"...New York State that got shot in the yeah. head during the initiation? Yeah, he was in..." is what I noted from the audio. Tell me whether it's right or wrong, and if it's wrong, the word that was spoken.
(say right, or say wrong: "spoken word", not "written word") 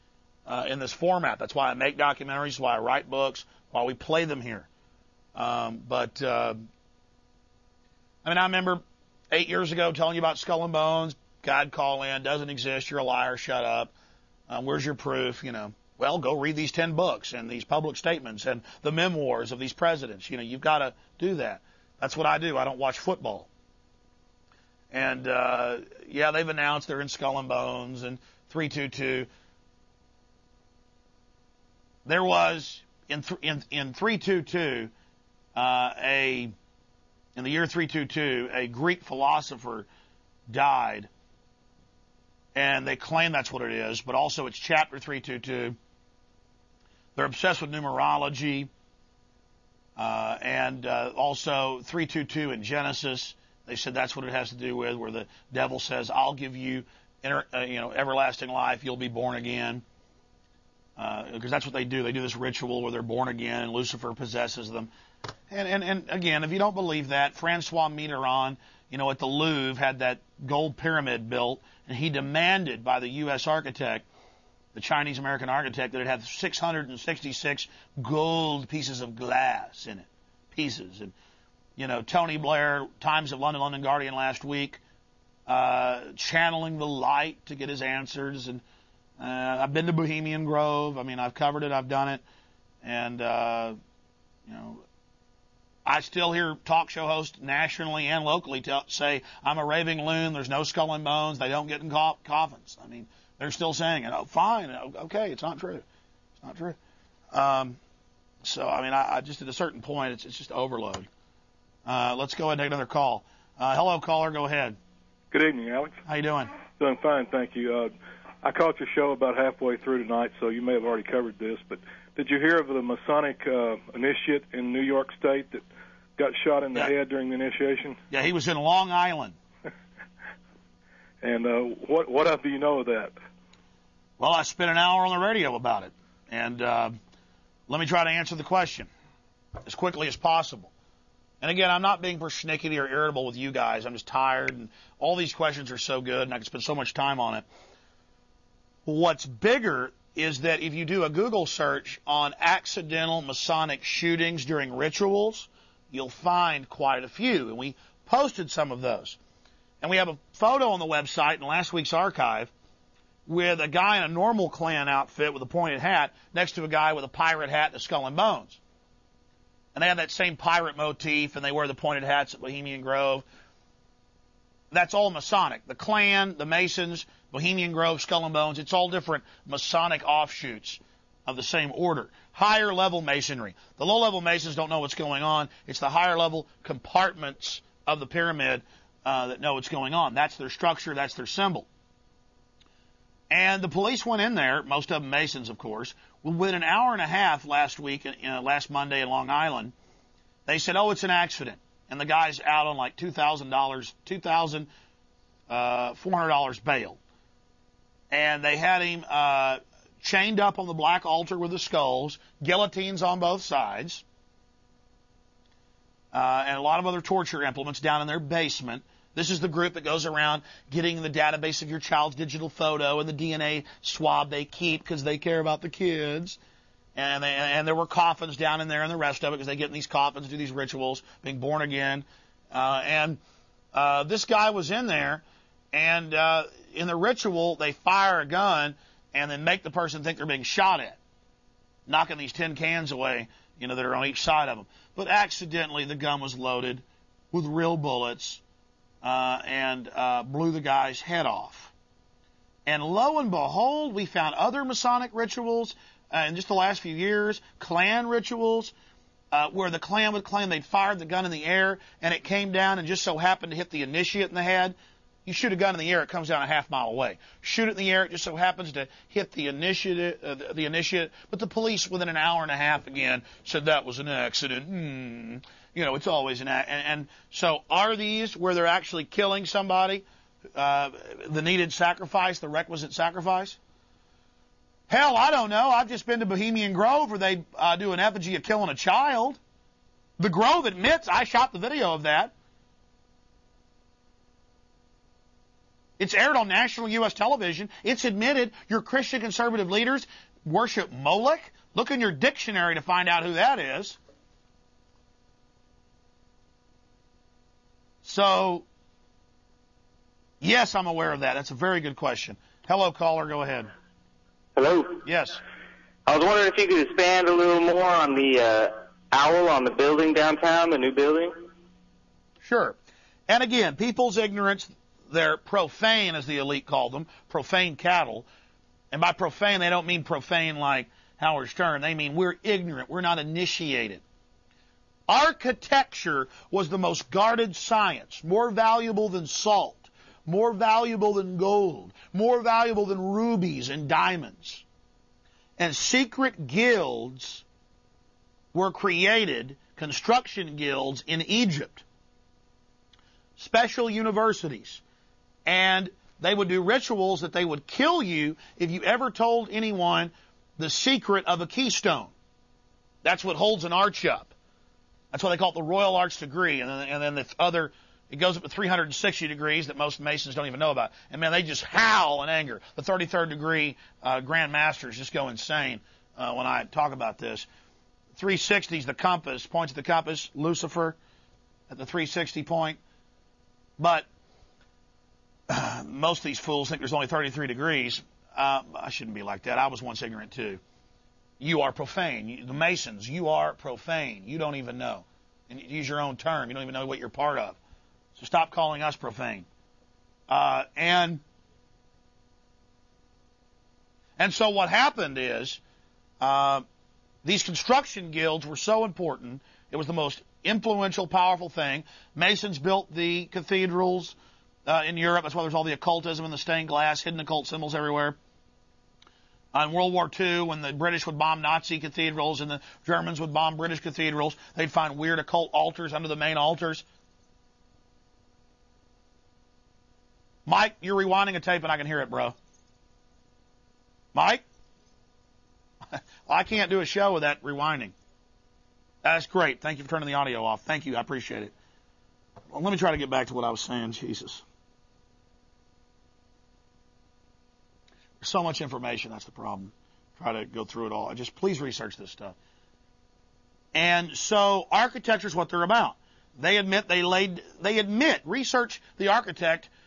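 right.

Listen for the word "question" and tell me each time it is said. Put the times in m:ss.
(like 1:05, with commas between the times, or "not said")
2:18, 2:25, 5:11.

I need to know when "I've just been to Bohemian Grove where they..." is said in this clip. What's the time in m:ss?
4:45.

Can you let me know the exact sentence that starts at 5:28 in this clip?
And by profane, they don't mean profane like Howard Stern.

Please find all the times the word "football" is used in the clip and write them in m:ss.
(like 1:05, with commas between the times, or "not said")
0:22.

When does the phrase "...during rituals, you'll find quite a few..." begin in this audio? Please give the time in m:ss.
2:34.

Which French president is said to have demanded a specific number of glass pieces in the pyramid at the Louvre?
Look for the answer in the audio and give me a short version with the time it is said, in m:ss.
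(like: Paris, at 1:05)
Francois Mitterrand, at 1:07.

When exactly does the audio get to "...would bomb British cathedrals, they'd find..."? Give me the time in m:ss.
7:03.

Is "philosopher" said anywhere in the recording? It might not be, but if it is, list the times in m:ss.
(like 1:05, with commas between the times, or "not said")
0:39.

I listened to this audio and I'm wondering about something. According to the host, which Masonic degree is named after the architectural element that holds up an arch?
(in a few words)
Royal Arch degree.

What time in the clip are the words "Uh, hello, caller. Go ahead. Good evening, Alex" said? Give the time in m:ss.
1:53.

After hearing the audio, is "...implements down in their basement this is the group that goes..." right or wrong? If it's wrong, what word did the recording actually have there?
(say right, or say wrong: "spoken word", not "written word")
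right.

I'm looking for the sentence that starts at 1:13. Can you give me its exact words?
architect the Chinese American architect, that it had 666 gold pieces of glass in it.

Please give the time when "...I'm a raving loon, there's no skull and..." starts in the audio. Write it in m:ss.
1:39.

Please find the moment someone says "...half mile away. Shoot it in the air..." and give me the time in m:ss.
4:26.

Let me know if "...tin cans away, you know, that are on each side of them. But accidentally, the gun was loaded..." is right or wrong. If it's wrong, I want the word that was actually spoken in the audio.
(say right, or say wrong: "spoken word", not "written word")
right.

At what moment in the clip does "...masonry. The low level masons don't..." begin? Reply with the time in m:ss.
3:03.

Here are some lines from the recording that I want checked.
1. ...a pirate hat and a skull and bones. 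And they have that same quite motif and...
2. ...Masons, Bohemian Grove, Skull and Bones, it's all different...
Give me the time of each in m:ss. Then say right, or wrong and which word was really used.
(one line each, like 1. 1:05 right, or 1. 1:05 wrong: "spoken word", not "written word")
1. 2:47 wrong: "pirate", not "quite"
2. 2:56 right.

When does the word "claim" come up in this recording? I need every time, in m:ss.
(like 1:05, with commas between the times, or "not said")
0:42, 4:20.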